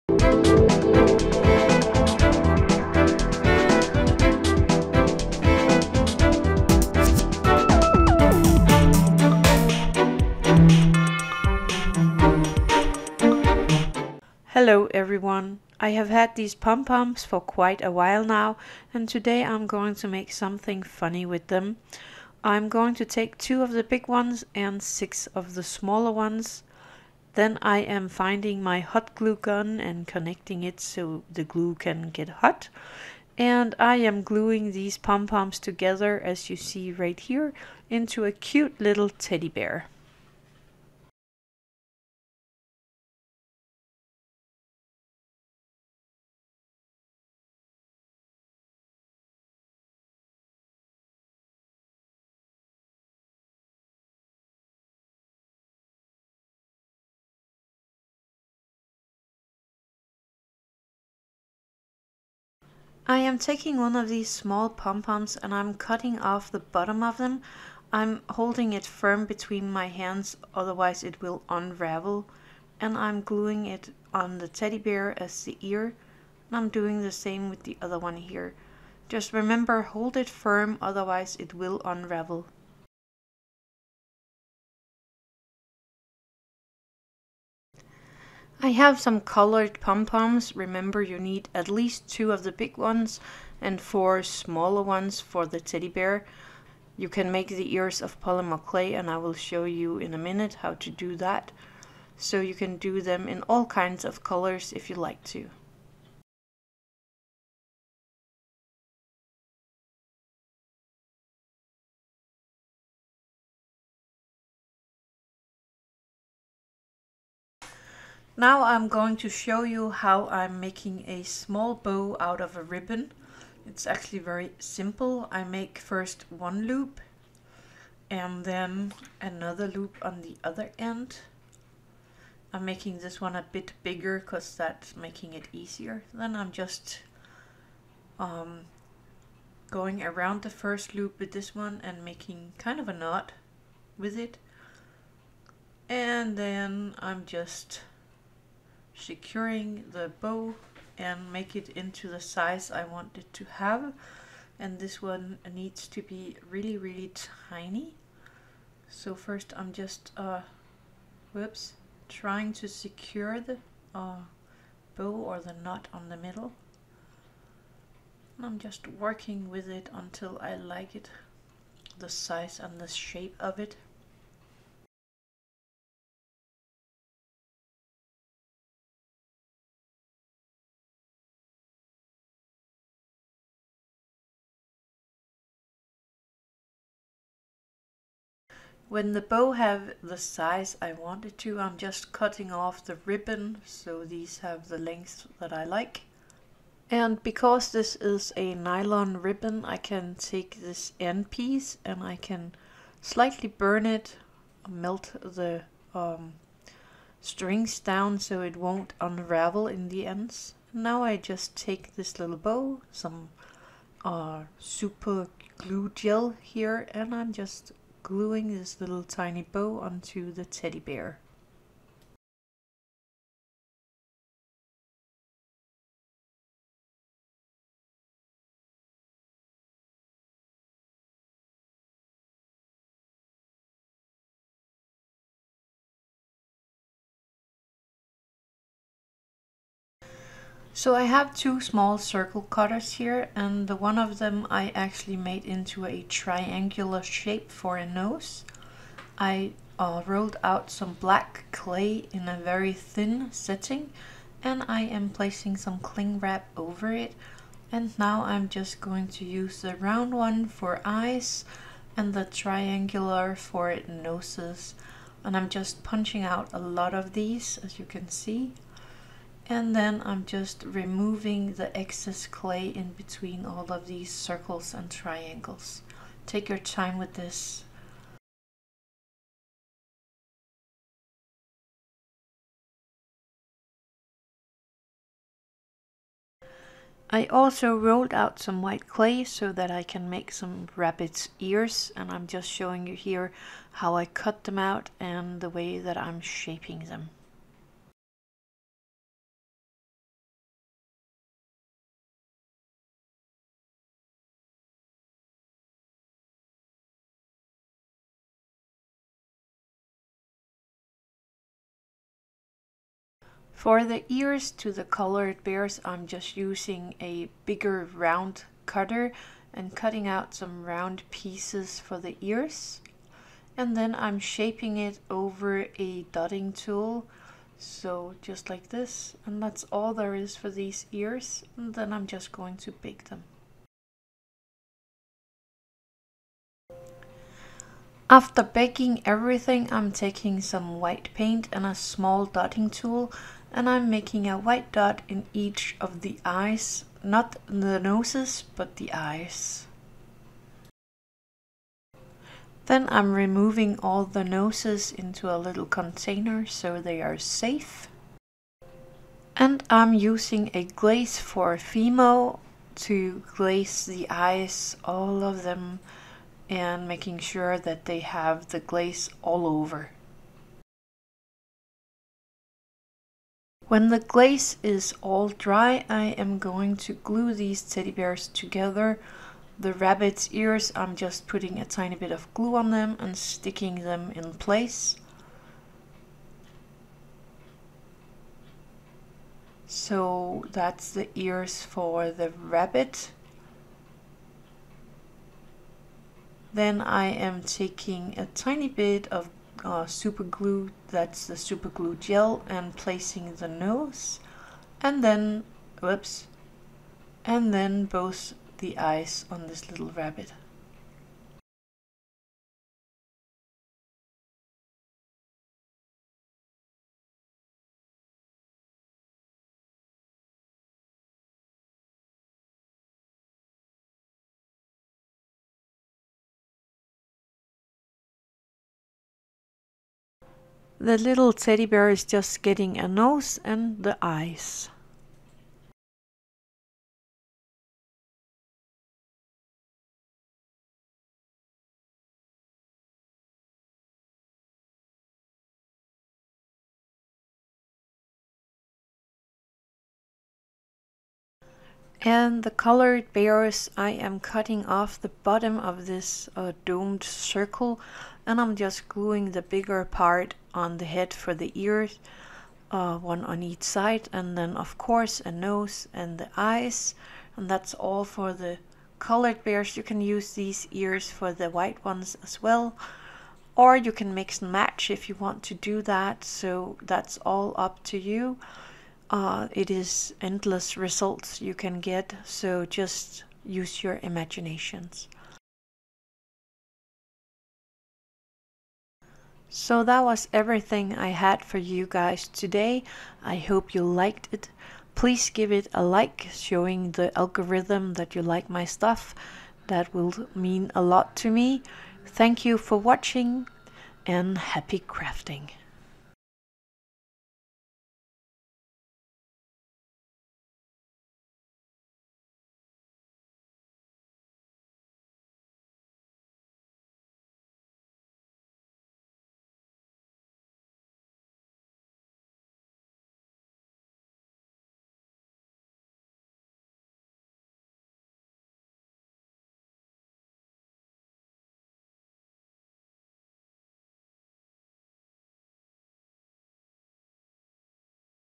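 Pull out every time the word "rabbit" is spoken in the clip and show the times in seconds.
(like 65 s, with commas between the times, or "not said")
290 s, 379 s, 392 s, 409 s.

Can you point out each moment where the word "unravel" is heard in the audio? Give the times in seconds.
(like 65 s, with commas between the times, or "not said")
71 s, 81 s, 208 s.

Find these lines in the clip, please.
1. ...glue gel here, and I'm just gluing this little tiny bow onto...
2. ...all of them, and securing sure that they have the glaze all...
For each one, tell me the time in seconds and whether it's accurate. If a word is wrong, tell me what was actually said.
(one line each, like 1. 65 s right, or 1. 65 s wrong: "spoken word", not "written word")
1. 215 s right
2. 364 s wrong: "making", not "securing".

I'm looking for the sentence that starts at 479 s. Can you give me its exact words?
Uh, it is endless results you can get, so just use your imaginations.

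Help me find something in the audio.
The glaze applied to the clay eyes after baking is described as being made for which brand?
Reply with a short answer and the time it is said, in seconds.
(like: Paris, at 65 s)
Fimo, at 361 s.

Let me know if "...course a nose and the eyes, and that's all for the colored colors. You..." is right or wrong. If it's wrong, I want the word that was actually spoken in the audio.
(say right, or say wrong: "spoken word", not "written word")
wrong: "bears", not "colors".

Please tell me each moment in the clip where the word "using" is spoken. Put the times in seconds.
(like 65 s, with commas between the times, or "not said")
316 s, 359 s.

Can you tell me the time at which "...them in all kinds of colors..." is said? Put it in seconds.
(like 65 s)
103 s.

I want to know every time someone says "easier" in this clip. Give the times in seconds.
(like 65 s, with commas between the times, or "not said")
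135 s.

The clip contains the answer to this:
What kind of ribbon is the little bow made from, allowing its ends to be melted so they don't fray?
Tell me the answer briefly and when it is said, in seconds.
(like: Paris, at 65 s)
nylon, at 198 s.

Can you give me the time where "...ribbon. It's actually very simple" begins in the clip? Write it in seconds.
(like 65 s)
122 s.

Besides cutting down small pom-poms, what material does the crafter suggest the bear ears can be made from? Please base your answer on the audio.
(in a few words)
polymer clay.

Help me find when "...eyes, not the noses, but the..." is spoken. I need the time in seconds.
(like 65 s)
346 s.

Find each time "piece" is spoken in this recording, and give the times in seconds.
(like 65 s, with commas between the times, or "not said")
201 s, 321 s.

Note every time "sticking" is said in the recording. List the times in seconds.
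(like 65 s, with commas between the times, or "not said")
383 s.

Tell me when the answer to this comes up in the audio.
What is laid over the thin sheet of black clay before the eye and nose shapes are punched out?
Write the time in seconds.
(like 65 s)
255 s.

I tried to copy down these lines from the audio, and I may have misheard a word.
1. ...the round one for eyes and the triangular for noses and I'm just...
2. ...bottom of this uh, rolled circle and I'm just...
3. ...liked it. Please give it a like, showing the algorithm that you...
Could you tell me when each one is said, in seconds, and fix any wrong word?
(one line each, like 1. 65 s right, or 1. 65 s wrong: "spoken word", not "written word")
1. 259 s right
2. 455 s wrong: "domed", not "rolled"
3. 493 s right.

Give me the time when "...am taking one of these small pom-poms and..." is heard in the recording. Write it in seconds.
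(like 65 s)
63 s.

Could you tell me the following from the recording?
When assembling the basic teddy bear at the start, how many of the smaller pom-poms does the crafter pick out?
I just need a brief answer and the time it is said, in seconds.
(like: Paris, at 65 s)
6, at 24 s.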